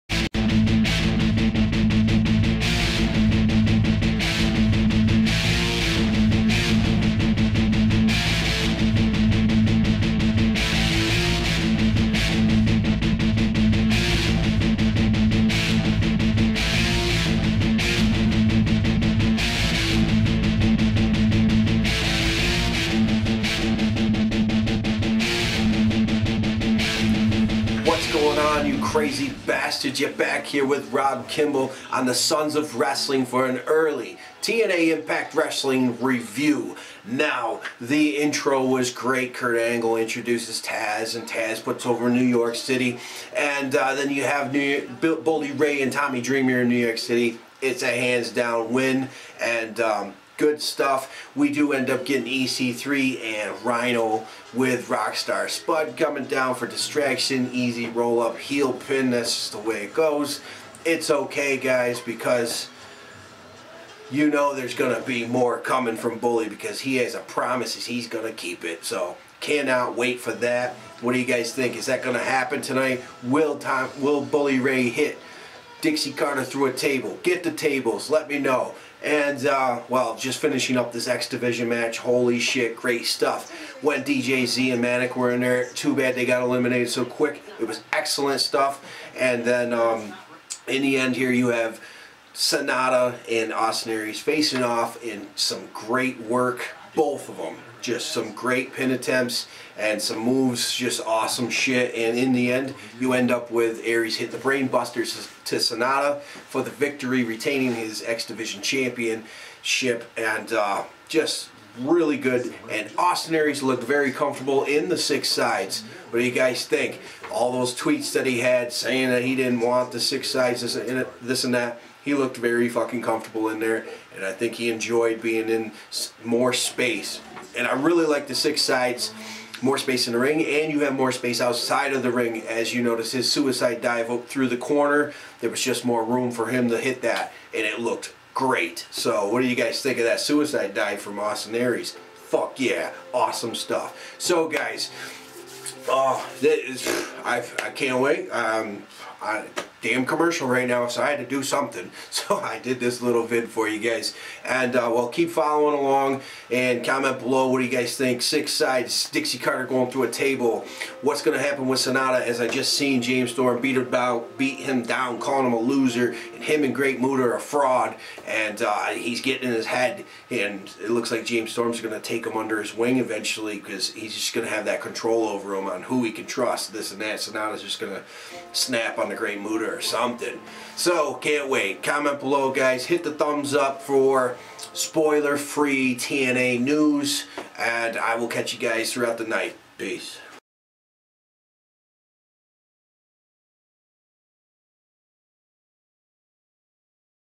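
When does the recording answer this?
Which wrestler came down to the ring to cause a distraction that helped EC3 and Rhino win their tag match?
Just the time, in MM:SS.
00:54.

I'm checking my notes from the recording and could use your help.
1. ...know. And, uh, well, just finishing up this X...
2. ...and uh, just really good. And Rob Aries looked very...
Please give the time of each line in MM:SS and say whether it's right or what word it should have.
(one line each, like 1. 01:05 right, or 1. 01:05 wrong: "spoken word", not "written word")
1. 01:18 right
2. 01:50 wrong: "Austin", not "Rob".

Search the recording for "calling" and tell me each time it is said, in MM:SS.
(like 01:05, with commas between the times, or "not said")
02:45.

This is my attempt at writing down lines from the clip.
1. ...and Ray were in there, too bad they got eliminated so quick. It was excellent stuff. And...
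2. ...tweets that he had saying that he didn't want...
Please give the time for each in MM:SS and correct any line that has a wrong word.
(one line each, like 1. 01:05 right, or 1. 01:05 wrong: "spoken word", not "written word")
1. 01:24 wrong: "Manik", not "Ray"
2. 01:57 right.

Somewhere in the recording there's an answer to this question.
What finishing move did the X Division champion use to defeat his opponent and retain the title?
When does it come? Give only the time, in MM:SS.
01:44.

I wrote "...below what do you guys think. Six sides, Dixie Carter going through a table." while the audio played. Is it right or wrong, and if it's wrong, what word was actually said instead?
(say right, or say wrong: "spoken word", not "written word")
right.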